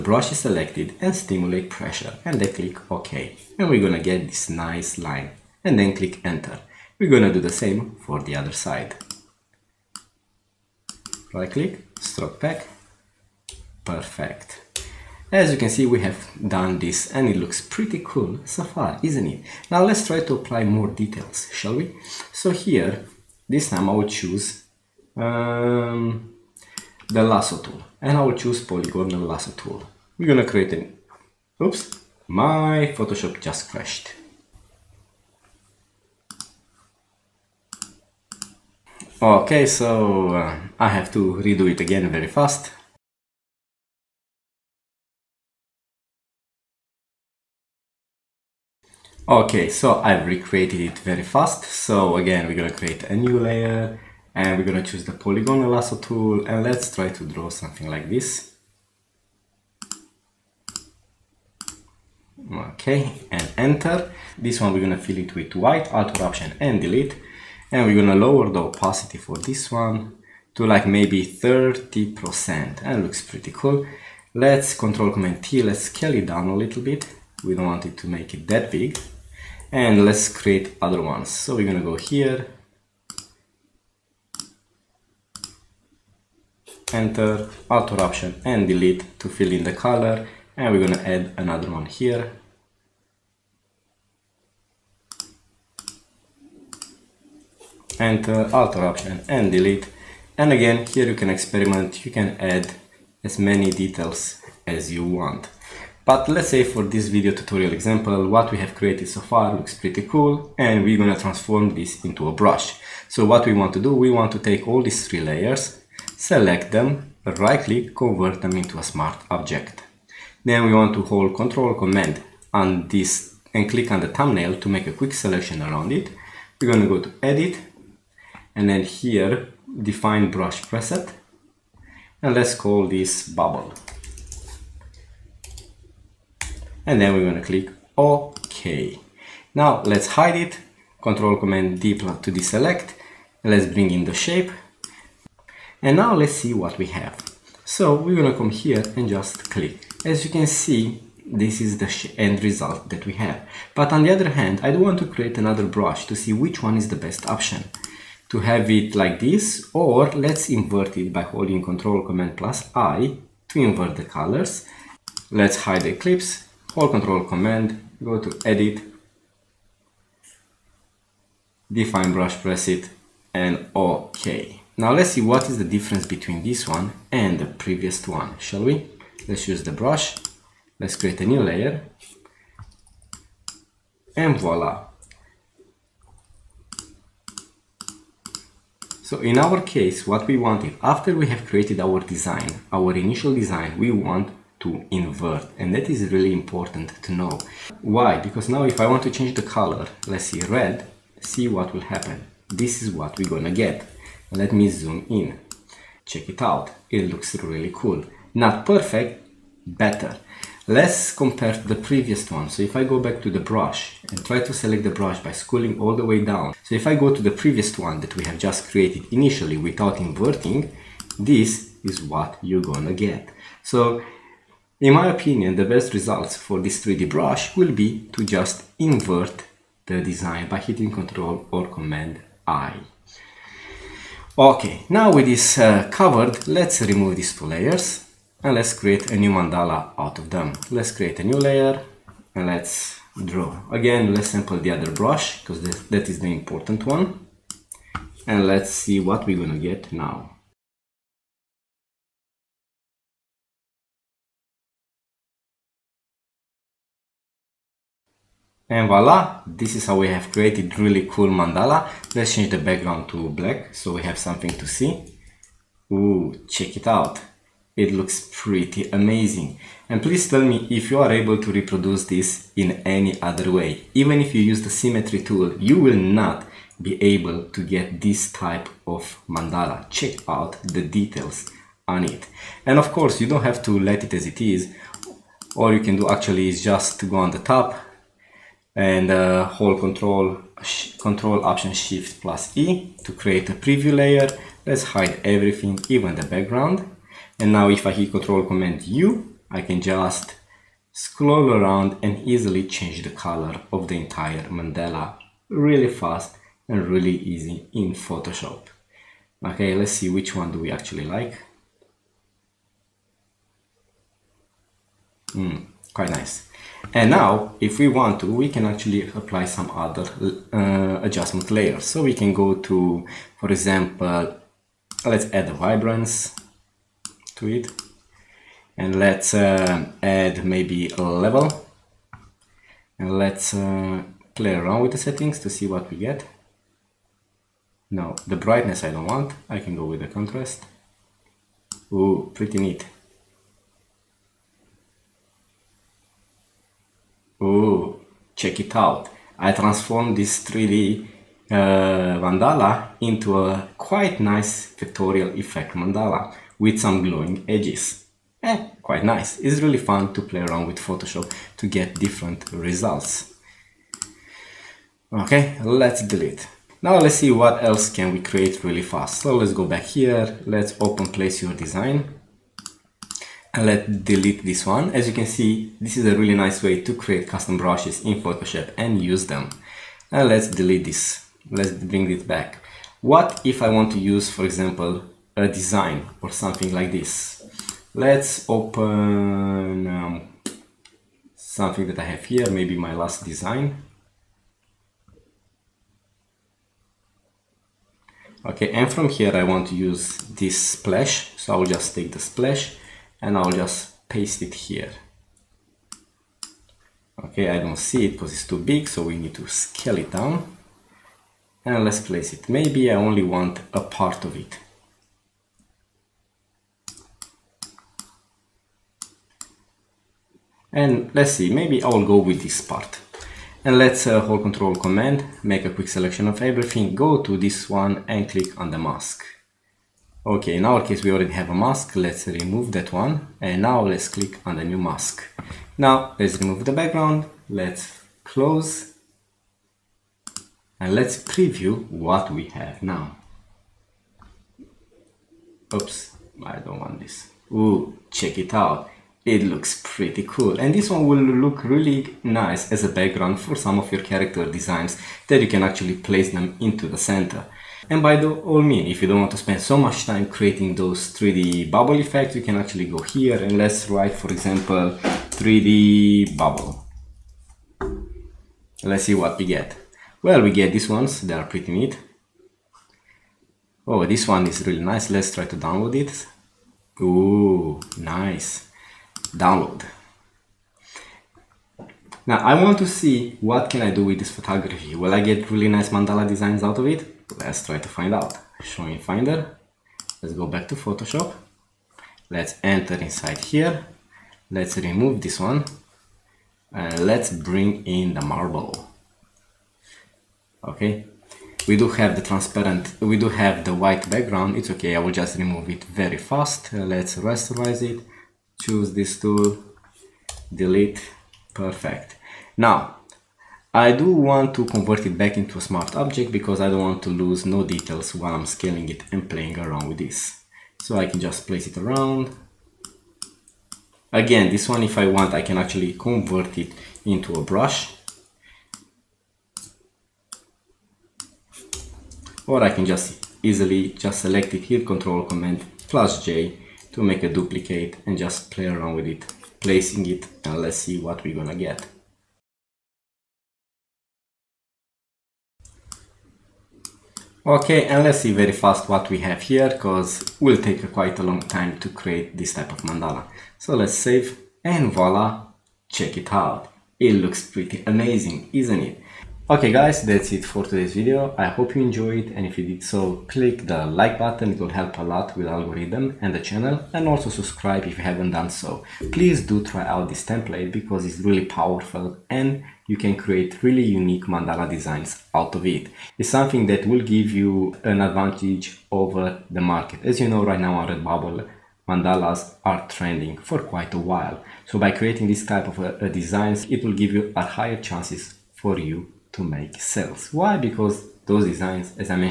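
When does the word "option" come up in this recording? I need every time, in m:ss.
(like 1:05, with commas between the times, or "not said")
1:06, 1:27, 1:38, 2:37, 4:51.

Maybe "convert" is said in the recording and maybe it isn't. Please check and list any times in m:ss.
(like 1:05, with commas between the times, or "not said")
1:57, 8:34, 8:45.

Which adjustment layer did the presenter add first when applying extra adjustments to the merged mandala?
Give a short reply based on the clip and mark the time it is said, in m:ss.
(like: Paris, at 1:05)
vibrance, at 5:25.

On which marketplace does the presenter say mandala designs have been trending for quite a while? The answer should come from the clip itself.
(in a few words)
Redbubble.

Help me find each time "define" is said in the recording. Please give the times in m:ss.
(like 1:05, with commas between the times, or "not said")
2:09, 2:51.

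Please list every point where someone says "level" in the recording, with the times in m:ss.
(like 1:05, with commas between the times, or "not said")
5:31.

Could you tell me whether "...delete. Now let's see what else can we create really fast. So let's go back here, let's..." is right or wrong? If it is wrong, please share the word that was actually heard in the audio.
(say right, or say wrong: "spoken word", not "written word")
right.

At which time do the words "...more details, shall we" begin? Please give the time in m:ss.
0:20.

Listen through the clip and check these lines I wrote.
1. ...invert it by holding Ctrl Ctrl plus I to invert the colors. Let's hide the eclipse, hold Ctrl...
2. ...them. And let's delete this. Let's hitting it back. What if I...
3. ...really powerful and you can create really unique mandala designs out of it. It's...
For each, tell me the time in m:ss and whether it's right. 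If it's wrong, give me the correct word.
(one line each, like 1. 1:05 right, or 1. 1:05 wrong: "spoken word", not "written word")
1. 2:40 wrong: "Command", not "Ctrl"
2. 6:19 wrong: "bring", not "hitting"
3. 9:31 right.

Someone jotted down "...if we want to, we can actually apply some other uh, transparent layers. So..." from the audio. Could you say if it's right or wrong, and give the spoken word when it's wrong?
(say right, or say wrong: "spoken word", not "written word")
wrong: "adjustment", not "transparent".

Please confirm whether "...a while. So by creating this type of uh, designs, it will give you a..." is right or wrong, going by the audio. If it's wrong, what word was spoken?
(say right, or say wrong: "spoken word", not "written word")
right.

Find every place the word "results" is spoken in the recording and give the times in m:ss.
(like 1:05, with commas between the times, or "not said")
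2:32, 3:45, 6:02.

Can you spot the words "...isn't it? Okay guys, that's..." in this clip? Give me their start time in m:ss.
9:18.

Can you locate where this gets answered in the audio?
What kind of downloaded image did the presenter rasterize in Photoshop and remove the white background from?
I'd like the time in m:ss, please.
8:18.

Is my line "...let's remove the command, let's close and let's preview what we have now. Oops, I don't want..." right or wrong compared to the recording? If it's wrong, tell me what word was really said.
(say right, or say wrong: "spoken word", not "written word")
wrong: "background", not "command".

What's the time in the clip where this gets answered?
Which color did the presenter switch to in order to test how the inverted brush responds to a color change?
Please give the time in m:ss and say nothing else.
3:20.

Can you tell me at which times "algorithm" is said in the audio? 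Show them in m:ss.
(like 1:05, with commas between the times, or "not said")
9:25.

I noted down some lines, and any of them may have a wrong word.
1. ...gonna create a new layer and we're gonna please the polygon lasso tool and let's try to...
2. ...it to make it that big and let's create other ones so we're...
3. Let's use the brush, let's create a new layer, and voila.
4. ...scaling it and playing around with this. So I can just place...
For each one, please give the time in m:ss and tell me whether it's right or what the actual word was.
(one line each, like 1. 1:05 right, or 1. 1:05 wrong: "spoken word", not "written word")
1. 0:52 wrong: "choose", not "please"
2. 1:17 right
3. 2:59 right
4. 8:38 right.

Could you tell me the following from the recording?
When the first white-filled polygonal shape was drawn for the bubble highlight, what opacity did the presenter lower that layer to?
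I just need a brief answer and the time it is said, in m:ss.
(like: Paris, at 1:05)
30 percent, at 1:11.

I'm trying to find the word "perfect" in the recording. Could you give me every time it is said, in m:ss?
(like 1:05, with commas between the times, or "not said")
0:13, 3:28, 8:31.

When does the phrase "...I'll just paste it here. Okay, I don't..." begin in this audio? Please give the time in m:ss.
6:43.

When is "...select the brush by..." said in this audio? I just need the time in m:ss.
3:34.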